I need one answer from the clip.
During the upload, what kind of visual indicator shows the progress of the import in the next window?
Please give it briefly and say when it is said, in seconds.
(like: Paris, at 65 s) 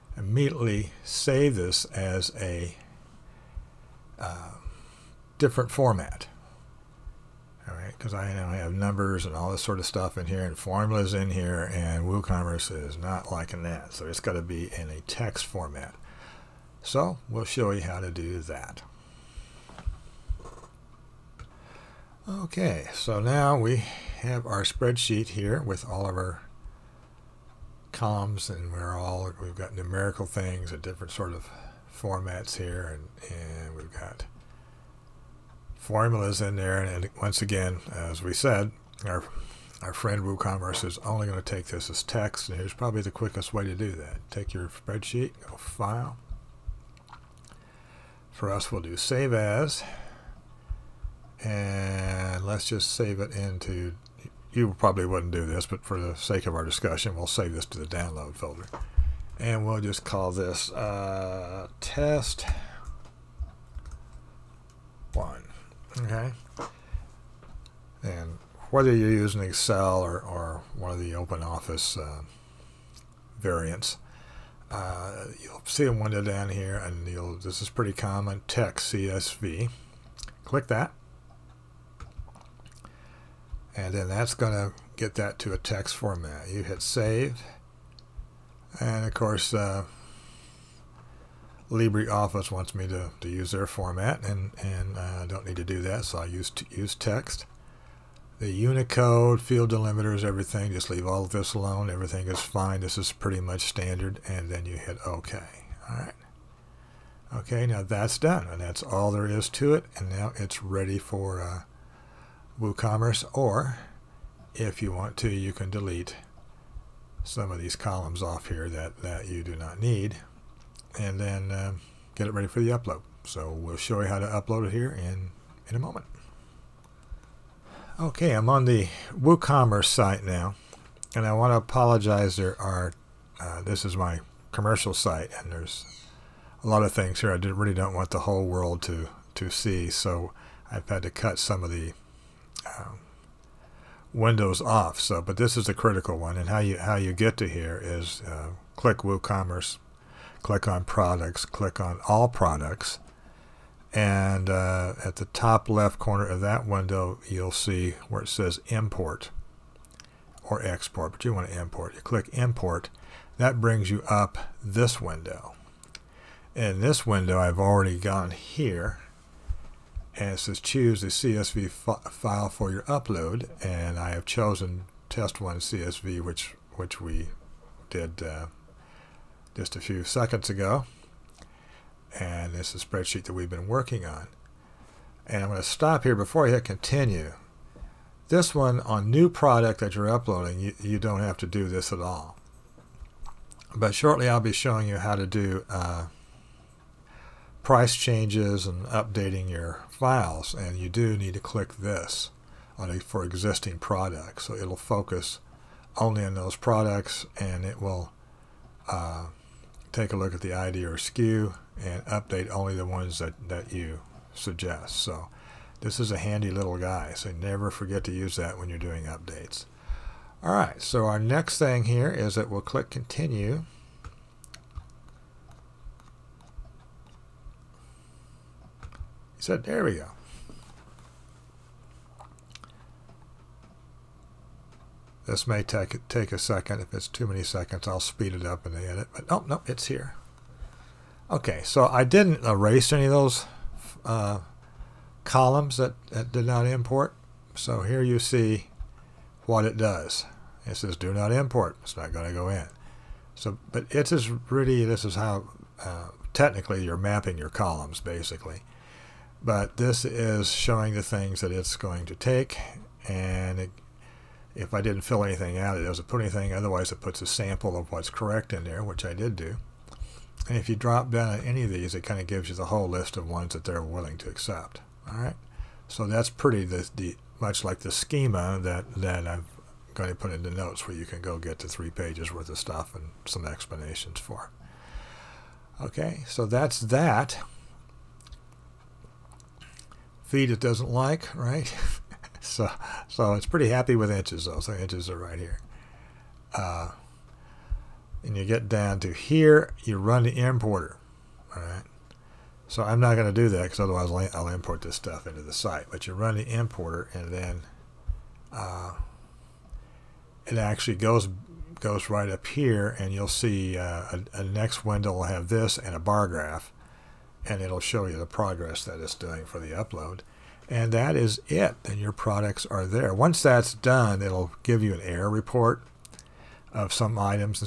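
bar graph, at 315 s.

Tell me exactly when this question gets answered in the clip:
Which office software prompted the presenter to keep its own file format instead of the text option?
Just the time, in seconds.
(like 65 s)
91 s.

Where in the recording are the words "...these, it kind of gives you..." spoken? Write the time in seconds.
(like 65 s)
271 s.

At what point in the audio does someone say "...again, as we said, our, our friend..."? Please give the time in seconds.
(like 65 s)
37 s.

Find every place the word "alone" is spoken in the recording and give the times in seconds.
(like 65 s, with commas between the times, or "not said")
101 s.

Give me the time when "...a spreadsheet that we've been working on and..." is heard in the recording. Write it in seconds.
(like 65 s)
182 s.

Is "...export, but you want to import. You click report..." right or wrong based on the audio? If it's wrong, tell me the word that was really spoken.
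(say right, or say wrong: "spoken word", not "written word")
wrong: "import", not "report".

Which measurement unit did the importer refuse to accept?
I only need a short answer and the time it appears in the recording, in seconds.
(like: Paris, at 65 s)
feet, at 290 s.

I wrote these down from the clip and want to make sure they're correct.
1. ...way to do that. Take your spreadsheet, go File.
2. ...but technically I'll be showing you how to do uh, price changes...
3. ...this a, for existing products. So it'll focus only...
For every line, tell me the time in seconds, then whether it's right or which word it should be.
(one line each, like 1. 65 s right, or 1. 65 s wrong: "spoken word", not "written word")
1. 43 s right
2. 193 s wrong: "shortly", not "technically"
3. 201 s right.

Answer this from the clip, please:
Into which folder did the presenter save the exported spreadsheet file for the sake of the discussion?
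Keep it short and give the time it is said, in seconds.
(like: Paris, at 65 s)
download folder, at 57 s.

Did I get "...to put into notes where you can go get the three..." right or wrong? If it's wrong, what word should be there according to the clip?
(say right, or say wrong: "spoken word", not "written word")
right.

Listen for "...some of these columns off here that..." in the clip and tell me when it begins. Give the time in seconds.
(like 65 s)
117 s.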